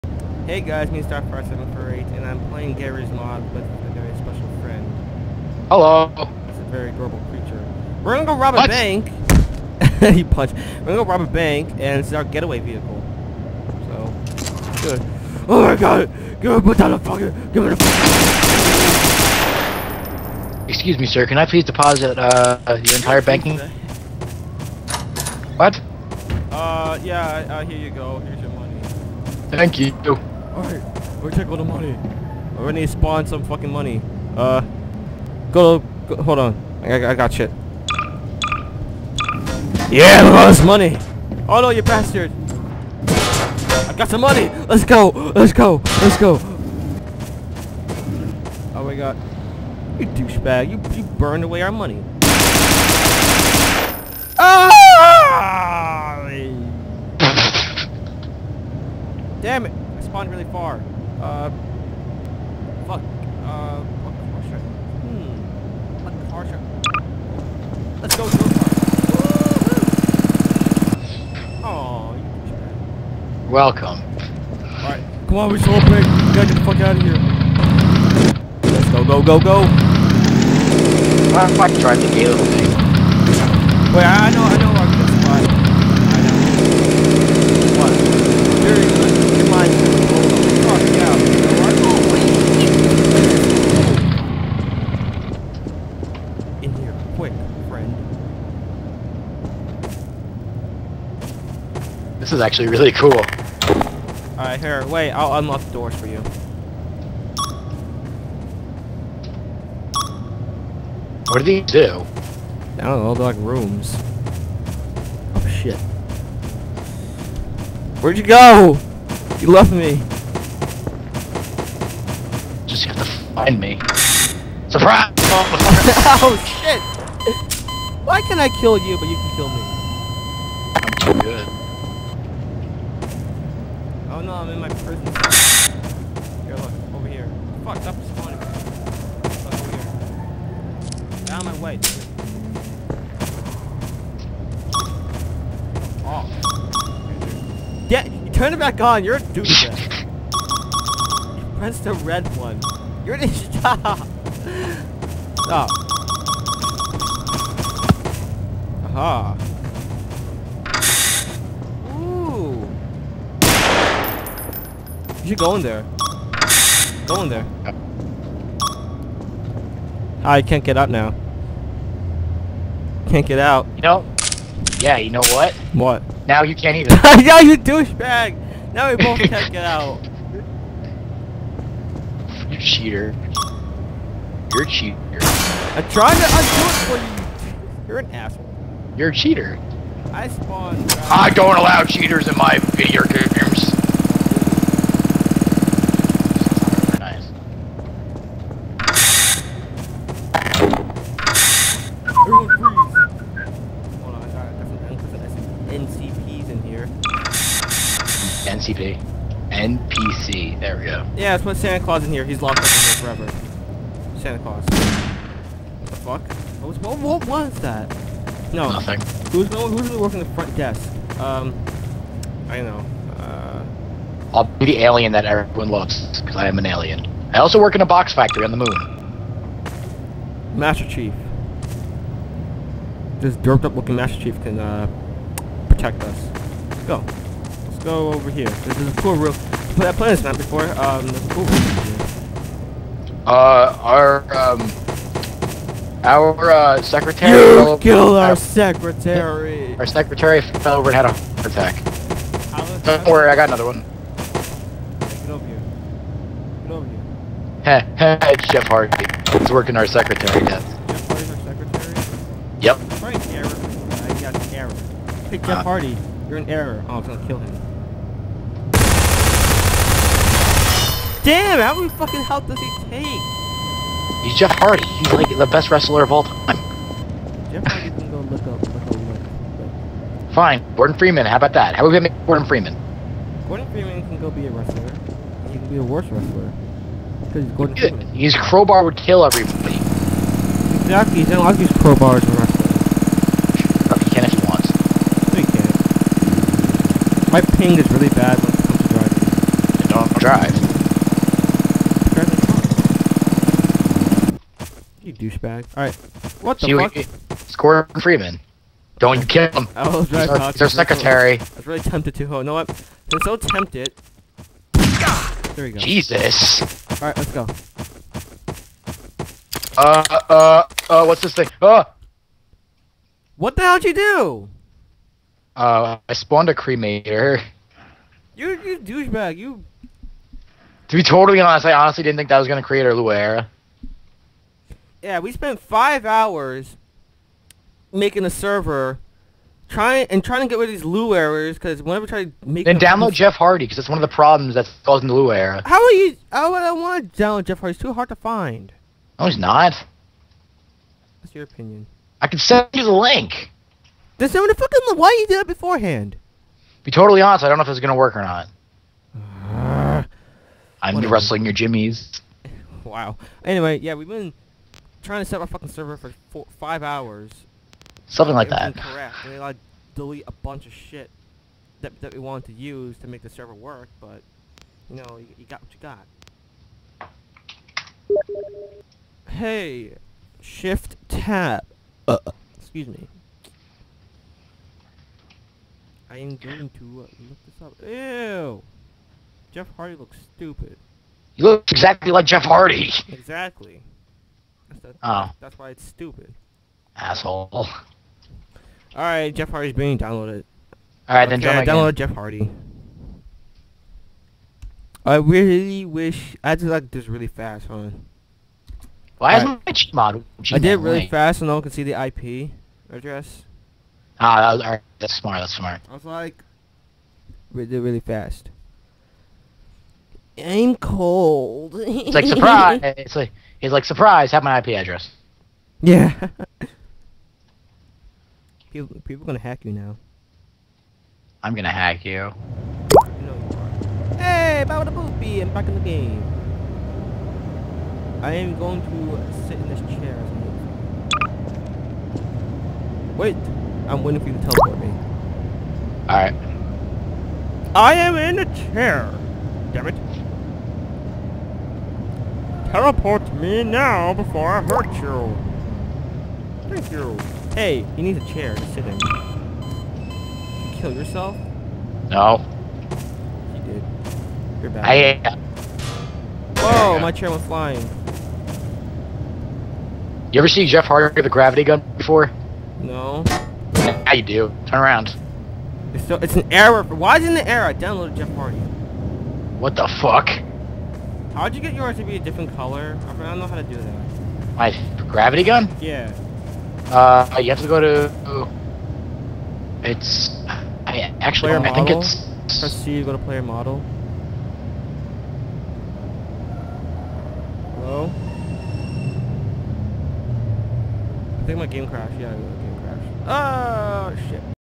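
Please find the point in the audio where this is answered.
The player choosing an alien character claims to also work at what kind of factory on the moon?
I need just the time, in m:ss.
3:47.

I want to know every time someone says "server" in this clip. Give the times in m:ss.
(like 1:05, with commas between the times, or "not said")
5:38, 6:05, 6:13.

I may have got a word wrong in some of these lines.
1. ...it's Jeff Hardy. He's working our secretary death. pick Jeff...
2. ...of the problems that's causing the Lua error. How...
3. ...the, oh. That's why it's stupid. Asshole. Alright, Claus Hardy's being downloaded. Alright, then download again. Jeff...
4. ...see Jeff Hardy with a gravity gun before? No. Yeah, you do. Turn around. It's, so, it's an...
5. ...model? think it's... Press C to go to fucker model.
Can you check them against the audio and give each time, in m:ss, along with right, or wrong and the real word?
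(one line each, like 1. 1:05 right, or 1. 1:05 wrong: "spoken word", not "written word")
1. 4:18 right
2. 5:44 right
3. 6:34 wrong: "Jeff", not "Claus"
4. 7:50 right
5. 8:11 wrong: "player", not "fucker".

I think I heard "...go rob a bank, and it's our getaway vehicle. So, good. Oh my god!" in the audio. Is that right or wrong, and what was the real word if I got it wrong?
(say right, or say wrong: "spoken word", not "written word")
right.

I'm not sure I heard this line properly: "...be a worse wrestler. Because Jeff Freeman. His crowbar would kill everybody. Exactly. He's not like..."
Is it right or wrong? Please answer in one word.
wrong.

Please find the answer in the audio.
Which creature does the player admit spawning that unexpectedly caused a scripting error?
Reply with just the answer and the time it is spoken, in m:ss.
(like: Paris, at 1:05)
Cremator, at 5:26.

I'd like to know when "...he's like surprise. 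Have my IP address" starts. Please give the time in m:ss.
7:03.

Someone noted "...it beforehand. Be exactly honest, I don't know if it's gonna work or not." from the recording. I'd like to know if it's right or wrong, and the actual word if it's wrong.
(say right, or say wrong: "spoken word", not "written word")
wrong: "totally", not "exactly".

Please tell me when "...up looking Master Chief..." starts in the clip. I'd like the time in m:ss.
3:53.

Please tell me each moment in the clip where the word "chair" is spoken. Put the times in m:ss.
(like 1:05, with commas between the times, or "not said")
7:19, 7:28, 7:38, 7:47.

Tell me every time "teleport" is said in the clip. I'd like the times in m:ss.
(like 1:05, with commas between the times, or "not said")
7:24, 7:32.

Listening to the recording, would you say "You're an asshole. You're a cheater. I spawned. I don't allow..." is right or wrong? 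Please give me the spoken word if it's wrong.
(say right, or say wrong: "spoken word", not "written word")
right.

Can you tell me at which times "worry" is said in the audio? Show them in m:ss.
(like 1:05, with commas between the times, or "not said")
4:13.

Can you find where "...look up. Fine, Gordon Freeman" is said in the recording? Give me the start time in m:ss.
4:38.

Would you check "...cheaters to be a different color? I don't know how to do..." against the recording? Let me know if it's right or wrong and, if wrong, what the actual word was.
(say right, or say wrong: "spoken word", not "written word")
wrong: "yours", not "cheaters".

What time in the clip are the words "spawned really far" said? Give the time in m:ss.
1:00.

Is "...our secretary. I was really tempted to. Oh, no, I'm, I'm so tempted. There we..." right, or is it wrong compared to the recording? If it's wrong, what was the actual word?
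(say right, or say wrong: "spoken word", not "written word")
right.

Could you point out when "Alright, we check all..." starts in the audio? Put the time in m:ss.
0:30.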